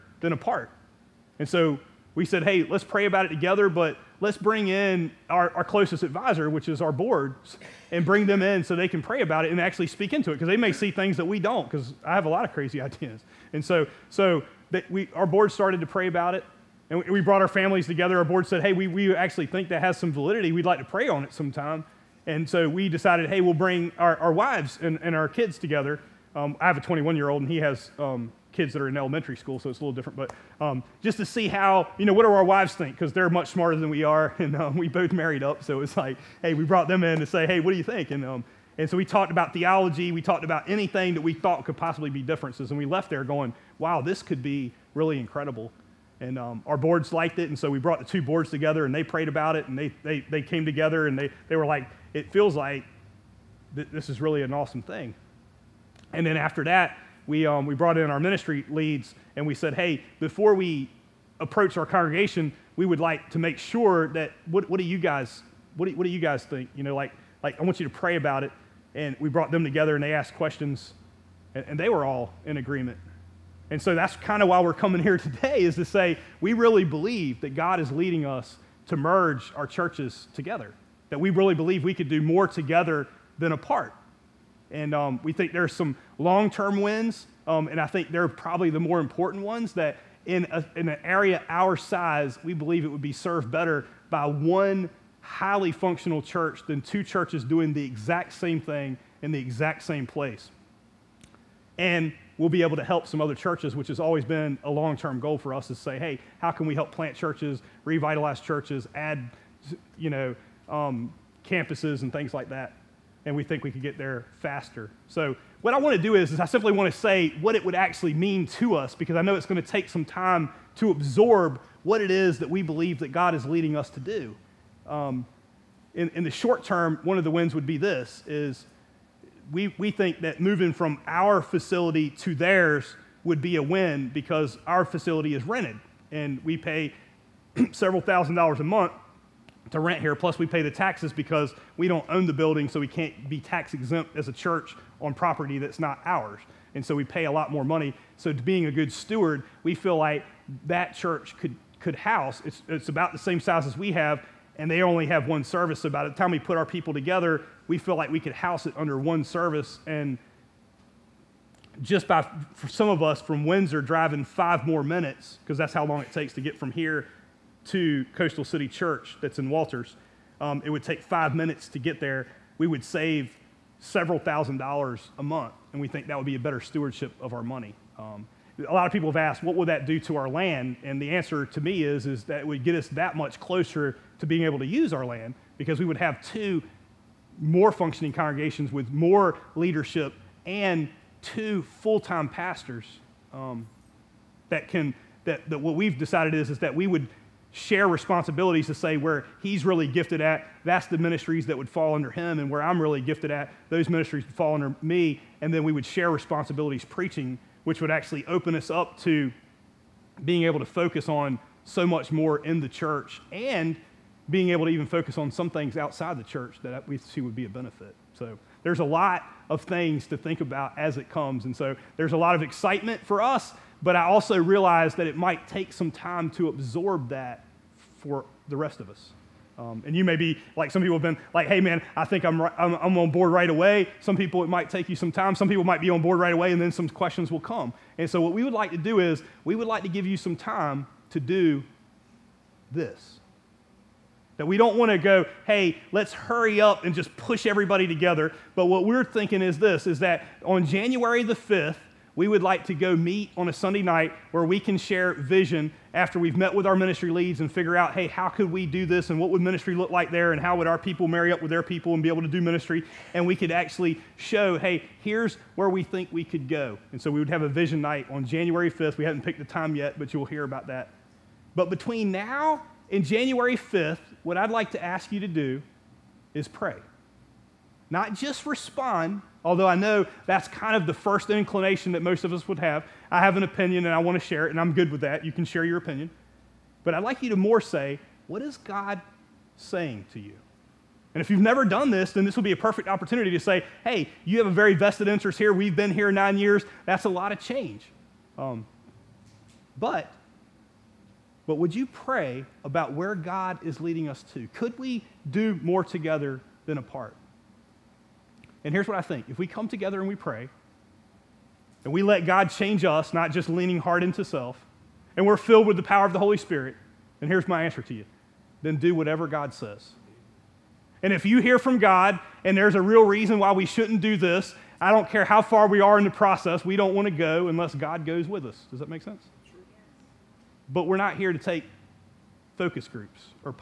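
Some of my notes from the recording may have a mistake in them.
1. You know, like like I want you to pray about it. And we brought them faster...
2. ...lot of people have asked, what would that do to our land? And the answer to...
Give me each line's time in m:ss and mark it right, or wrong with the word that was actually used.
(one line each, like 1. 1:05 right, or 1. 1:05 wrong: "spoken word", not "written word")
1. 1:06 wrong: "together", not "faster"
2. 2:58 right.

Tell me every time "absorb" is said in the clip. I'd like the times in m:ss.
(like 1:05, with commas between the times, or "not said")
2:00, 3:46.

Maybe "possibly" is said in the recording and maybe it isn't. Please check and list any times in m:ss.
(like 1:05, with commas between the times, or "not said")
0:41.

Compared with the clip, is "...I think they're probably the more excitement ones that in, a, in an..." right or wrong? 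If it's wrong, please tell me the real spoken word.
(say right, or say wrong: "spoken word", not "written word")
wrong: "important", not "excitement".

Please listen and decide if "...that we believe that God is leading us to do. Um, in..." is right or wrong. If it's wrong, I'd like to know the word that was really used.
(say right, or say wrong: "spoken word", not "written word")
right.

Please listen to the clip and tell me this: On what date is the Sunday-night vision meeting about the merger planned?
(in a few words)
January 5th.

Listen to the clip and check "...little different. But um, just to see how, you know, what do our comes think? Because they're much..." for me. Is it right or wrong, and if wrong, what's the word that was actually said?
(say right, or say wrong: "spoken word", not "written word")
wrong: "wives", not "comes".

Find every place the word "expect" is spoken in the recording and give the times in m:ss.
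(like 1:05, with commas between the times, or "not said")
not said.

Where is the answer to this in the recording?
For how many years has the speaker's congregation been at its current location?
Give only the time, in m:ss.
4:56.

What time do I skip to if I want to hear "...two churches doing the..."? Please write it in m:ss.
1:36.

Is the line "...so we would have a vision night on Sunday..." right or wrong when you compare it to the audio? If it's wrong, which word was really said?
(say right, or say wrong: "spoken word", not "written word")
wrong: "January", not "Sunday".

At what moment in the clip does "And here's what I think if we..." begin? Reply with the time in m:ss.
5:08.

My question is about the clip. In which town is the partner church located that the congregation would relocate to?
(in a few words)
Walters.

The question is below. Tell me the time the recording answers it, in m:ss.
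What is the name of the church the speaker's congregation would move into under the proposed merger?
2:48.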